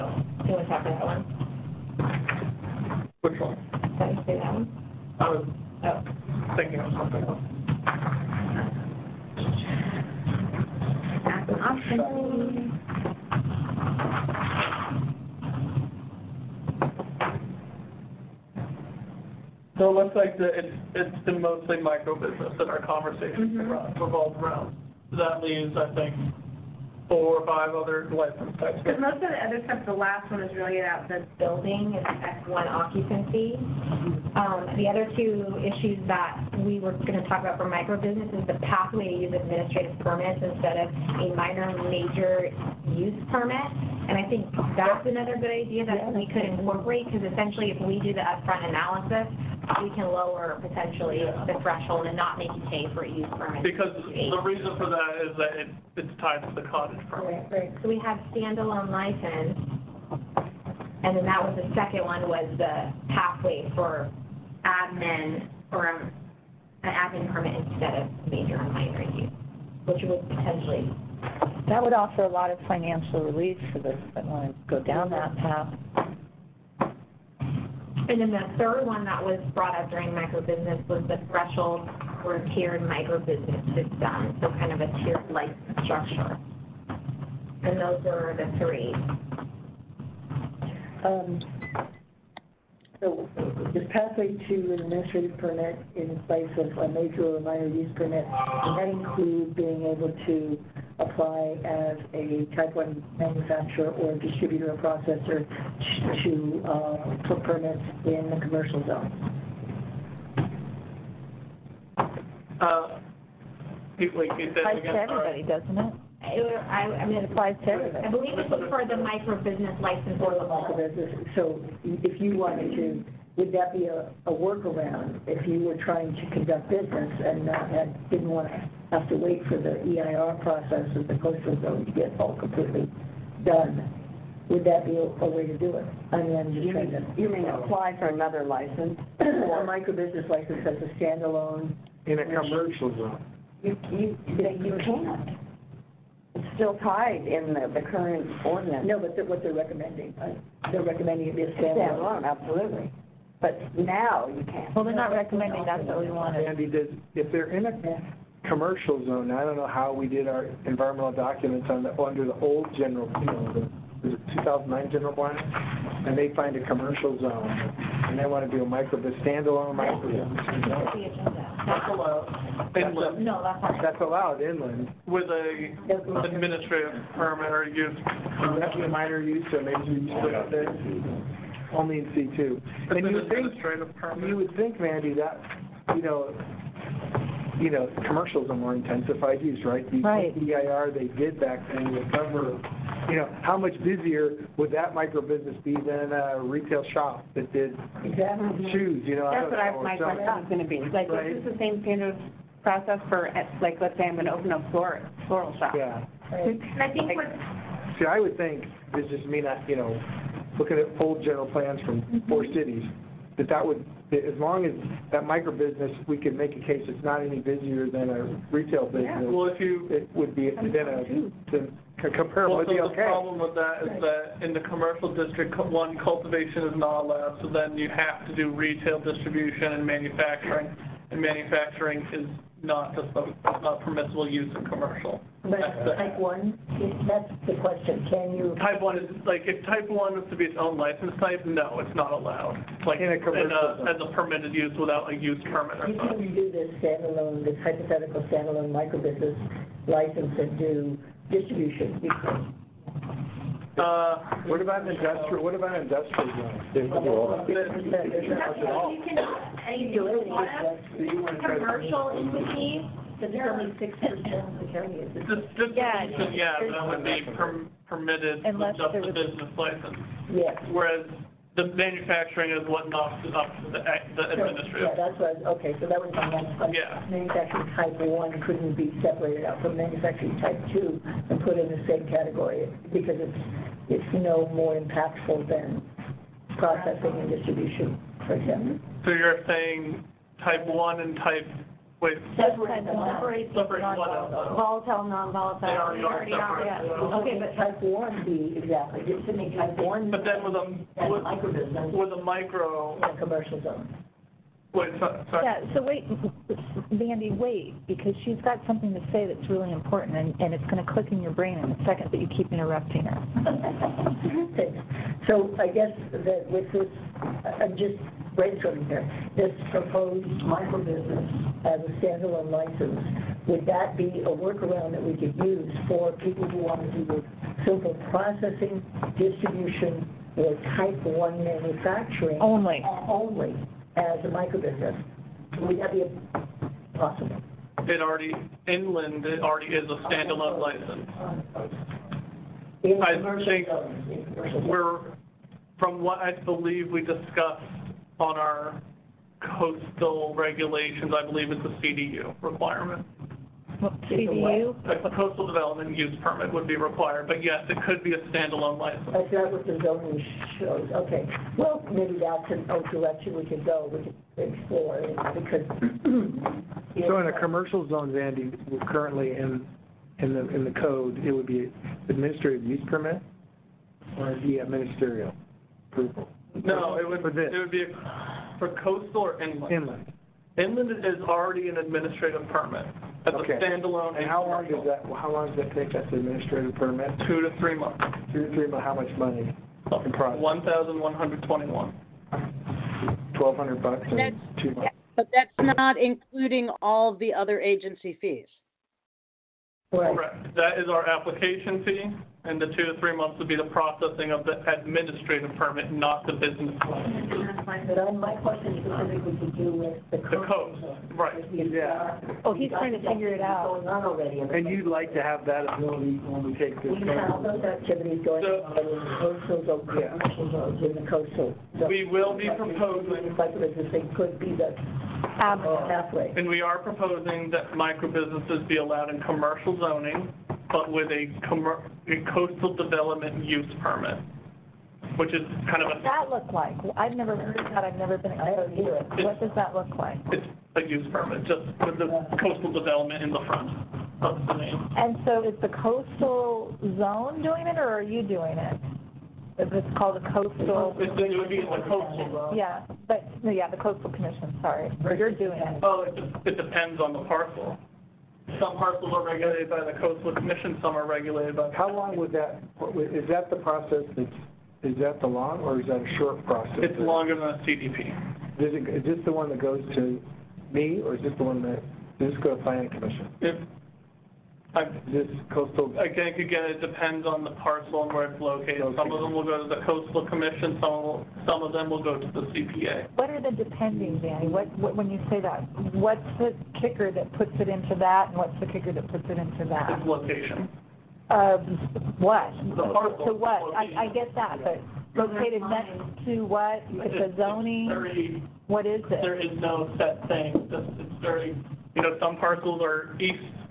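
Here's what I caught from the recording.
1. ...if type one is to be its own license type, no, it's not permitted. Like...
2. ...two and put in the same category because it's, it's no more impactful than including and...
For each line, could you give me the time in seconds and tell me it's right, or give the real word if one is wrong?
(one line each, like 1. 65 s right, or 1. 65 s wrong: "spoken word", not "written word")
1. 239 s wrong: "allowed", not "permitted"
2. 280 s wrong: "processing", not "including".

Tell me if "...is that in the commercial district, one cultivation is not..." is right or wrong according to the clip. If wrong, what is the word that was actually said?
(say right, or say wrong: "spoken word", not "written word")
right.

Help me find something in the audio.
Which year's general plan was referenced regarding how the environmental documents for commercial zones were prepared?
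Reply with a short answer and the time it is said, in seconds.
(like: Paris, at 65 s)
2009, at 164 s.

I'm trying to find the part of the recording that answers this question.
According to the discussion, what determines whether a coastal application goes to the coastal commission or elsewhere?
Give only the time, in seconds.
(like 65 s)
490 s.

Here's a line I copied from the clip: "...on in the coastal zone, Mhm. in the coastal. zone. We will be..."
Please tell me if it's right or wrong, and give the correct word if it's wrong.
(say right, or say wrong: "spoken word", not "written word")
wrong: "Yeah", not "Mhm".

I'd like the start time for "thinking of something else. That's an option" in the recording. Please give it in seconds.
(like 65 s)
6 s.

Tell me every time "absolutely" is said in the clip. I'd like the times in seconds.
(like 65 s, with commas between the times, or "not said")
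152 s, 425 s.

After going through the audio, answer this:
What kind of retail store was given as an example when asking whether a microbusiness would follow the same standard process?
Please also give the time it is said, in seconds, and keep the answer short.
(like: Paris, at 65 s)
floral shop, at 205 s.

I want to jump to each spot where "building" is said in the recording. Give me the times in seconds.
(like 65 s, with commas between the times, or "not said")
31 s.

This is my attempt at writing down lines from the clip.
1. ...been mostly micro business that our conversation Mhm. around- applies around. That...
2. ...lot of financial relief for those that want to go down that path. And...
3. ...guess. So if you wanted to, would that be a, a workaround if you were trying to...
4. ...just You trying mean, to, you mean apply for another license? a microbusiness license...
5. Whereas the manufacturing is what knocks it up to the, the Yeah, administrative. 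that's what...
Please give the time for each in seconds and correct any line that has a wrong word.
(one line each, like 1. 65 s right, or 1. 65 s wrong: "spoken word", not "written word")
1. 21 s wrong: "revolves", not "applies"
2. 72 s right
3. 120 s wrong: "business", not "guess"
4. 136 s right
5. 270 s right.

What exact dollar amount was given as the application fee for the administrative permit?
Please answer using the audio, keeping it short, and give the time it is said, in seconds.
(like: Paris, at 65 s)
$1,121, at 390 s.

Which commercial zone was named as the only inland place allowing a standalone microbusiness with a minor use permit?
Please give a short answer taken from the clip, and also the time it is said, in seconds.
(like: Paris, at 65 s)
C2, at 182 s.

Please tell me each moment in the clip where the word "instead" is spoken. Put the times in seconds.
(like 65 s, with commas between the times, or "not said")
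40 s, 67 s.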